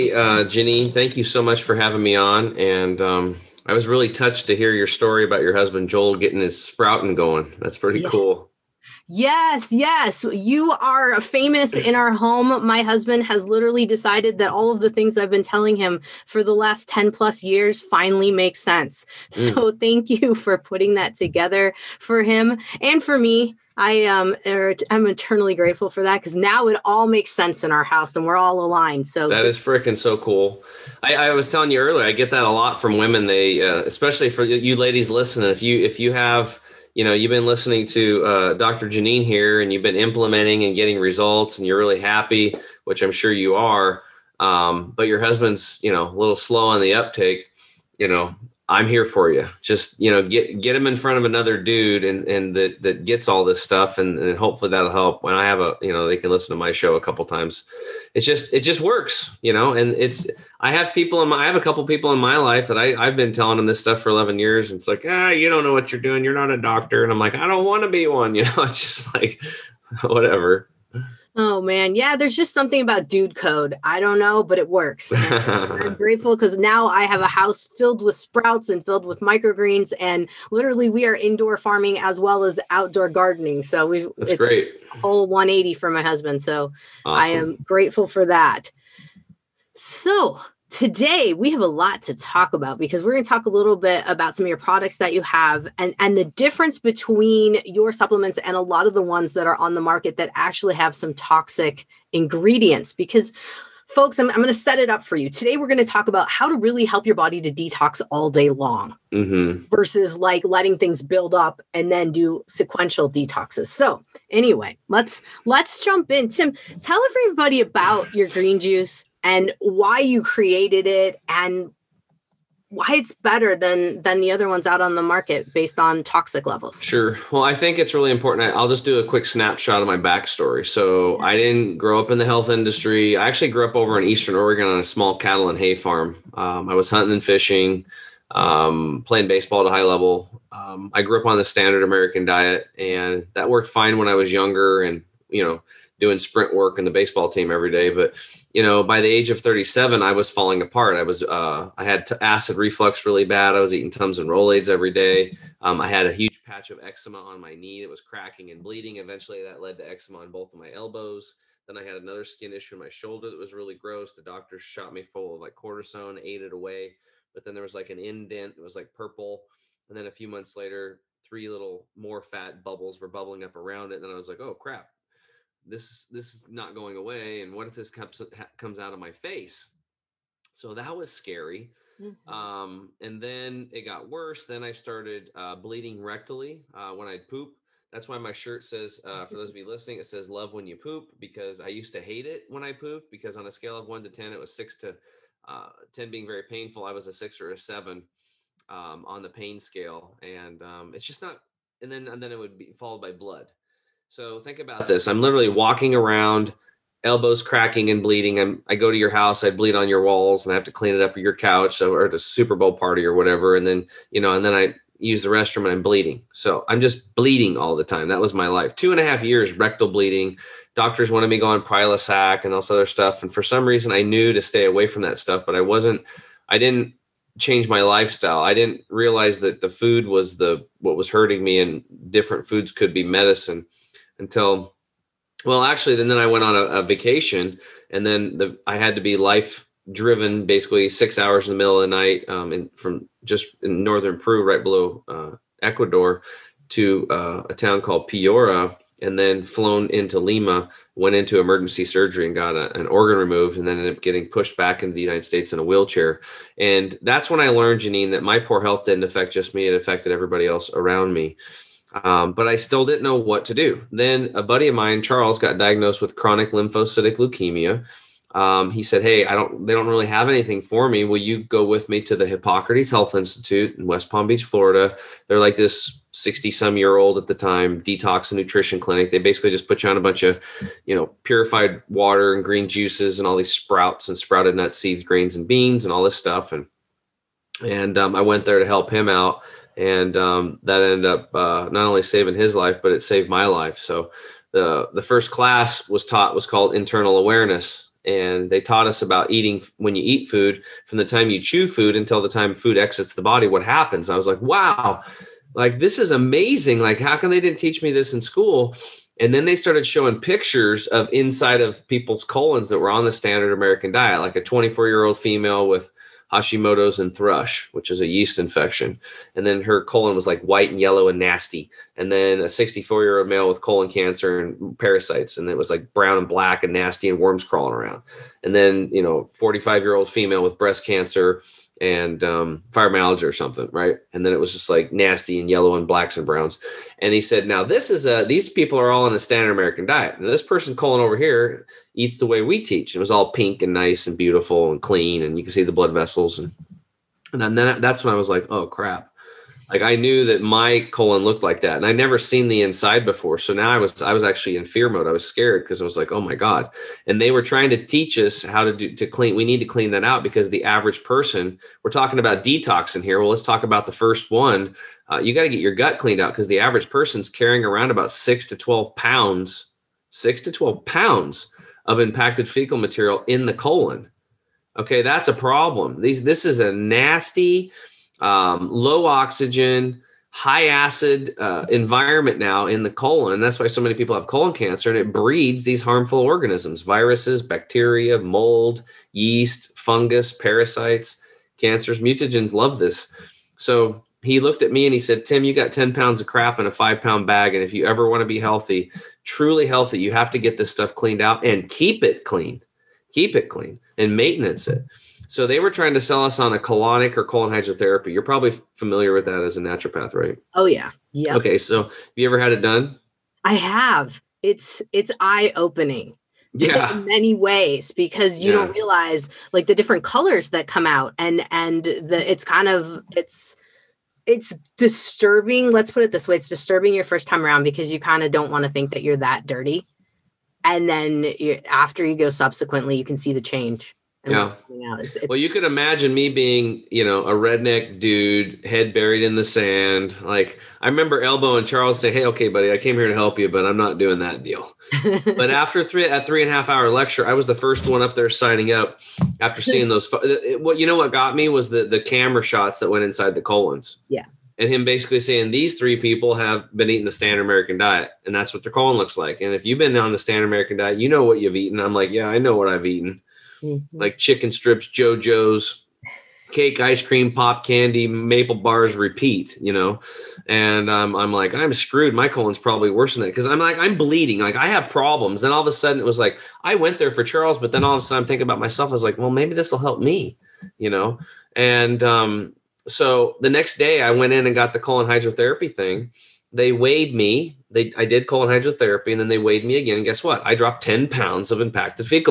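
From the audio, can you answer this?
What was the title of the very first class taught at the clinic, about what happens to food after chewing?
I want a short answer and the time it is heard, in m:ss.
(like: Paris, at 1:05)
Internal awareness, at 4:56.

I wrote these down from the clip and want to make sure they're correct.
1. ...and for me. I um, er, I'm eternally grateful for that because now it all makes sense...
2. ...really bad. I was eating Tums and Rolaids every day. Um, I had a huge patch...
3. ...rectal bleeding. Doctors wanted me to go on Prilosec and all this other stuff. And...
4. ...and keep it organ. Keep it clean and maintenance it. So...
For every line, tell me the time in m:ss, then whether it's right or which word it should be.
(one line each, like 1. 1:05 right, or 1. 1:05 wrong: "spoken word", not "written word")
1. 0:22 right
2. 2:33 right
3. 3:39 right
4. 6:41 wrong: "clean", not "organ".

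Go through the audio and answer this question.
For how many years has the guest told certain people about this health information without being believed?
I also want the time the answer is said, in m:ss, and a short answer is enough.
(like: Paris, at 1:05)
11, at 1:04.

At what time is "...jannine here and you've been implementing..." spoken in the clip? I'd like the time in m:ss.
0:38.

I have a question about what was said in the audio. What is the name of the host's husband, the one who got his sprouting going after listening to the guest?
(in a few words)
Joel.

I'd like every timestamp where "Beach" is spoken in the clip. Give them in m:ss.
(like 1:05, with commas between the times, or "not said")
4:34.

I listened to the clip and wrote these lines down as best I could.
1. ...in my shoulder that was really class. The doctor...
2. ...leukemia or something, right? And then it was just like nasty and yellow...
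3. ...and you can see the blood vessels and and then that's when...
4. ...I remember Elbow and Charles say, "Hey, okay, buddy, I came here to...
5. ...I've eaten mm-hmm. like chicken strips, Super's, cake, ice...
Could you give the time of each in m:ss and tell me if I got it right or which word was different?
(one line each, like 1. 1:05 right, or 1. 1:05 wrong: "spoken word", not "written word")
1. 2:42 wrong: "gross", not "class"
2. 5:32 wrong: "fibromyalgia", not "leukemia"
3. 5:45 right
4. 7:20 right
5. 7:42 wrong: "JoJo", not "Super".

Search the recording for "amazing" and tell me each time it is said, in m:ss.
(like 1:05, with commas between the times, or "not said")
5:06.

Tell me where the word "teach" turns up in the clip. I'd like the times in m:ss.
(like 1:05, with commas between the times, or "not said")
5:07, 5:42, 5:57.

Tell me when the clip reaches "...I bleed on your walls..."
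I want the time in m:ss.
3:29.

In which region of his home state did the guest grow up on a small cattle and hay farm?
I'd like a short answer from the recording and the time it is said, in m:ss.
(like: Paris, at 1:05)
Eastern Oregon, at 2:14.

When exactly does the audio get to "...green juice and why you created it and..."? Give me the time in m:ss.
1:58.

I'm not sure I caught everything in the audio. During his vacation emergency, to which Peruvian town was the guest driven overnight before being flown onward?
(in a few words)
Piura.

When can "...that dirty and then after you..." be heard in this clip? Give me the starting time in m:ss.
7:09.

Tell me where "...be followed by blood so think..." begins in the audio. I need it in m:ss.
3:22.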